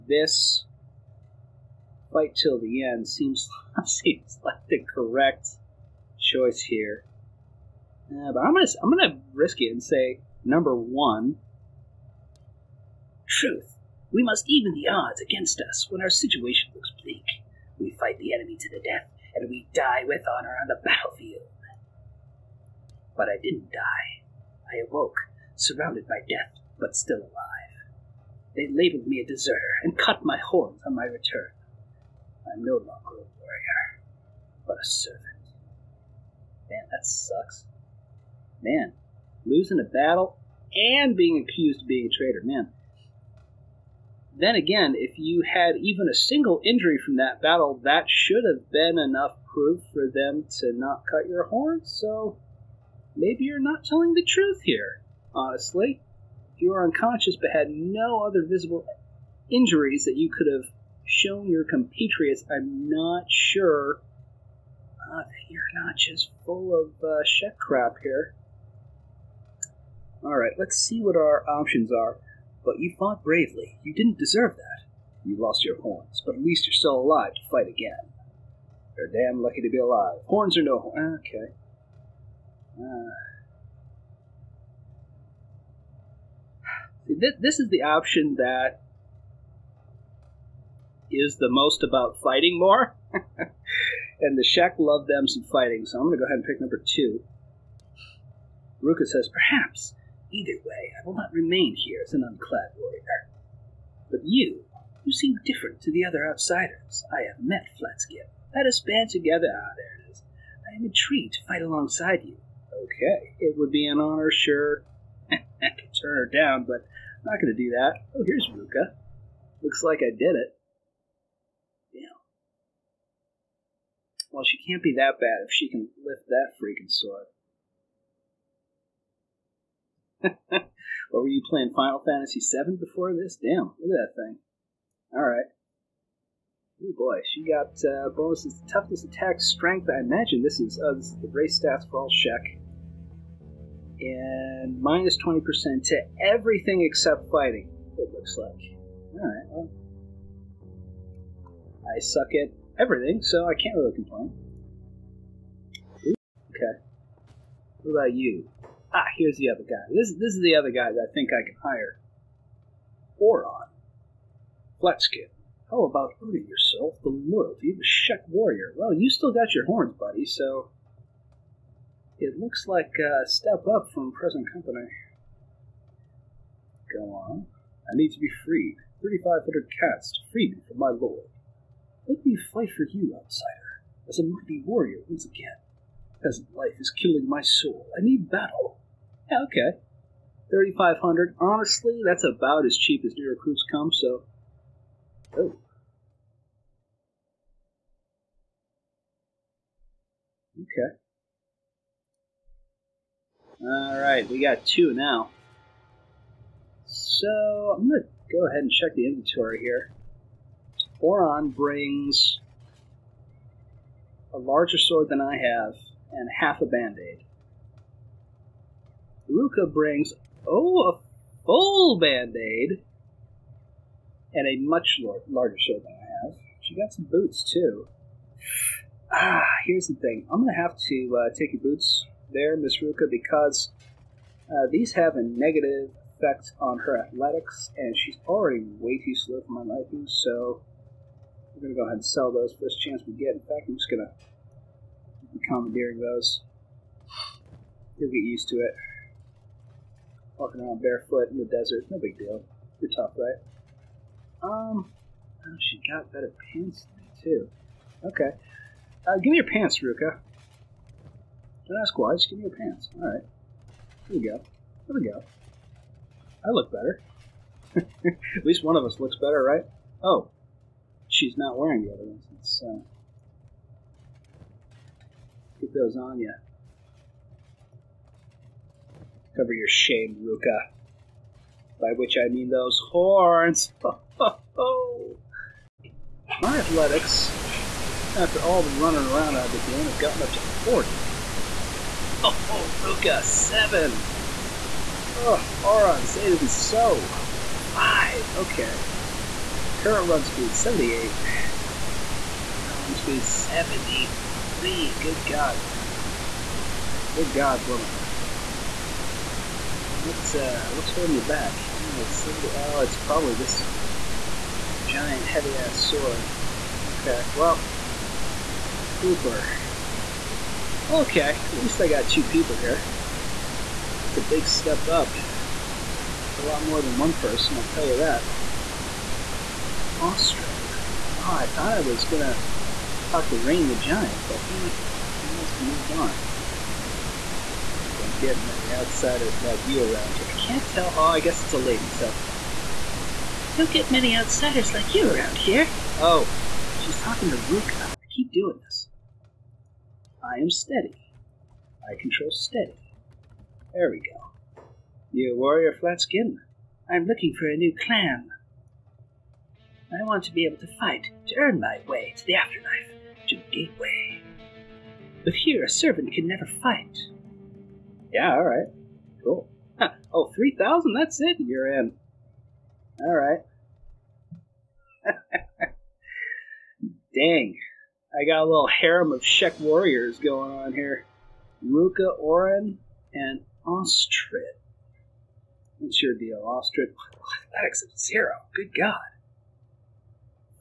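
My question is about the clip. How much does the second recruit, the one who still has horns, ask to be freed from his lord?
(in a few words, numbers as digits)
3,500 cats.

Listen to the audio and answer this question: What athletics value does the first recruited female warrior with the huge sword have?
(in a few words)
7.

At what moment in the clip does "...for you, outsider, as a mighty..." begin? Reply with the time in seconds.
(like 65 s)
182 s.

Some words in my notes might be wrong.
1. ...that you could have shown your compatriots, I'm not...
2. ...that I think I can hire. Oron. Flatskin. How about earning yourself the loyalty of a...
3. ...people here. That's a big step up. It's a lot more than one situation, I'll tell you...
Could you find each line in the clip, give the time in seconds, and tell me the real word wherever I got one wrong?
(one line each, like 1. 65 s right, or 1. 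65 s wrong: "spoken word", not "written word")
1. 60 s right
2. 160 s right
3. 322 s wrong: "person", not "situation".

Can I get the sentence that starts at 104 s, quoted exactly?
But you, you seem different to the other outsiders I have met, Flatskin, Let us band together.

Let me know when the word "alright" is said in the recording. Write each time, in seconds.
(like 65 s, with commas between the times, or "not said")
135 s, 149 s, 203 s, 262 s, 368 s, 373 s.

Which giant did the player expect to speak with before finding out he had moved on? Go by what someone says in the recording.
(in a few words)
Rain the Giant.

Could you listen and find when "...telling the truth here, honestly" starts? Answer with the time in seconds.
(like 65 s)
53 s.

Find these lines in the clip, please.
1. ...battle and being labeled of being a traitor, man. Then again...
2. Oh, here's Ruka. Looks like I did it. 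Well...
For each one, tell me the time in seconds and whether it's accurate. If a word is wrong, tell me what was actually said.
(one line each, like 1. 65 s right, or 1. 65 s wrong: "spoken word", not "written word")
1. 39 s wrong: "accused", not "labeled"
2. 118 s right.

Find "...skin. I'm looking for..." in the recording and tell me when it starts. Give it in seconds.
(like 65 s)
356 s.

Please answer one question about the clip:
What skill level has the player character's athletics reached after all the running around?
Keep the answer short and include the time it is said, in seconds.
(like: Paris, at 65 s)
40, at 290 s.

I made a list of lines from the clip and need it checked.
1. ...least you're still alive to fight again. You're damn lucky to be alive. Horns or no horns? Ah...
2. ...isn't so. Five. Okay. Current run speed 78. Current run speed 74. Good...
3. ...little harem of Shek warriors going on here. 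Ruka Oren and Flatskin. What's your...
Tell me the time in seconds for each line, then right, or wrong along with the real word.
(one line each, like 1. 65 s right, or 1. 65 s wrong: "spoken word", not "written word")
1. 76 s right
2. 296 s wrong: "73", not "74"
3. 378 s wrong: "Ostrid", not "Flatskin".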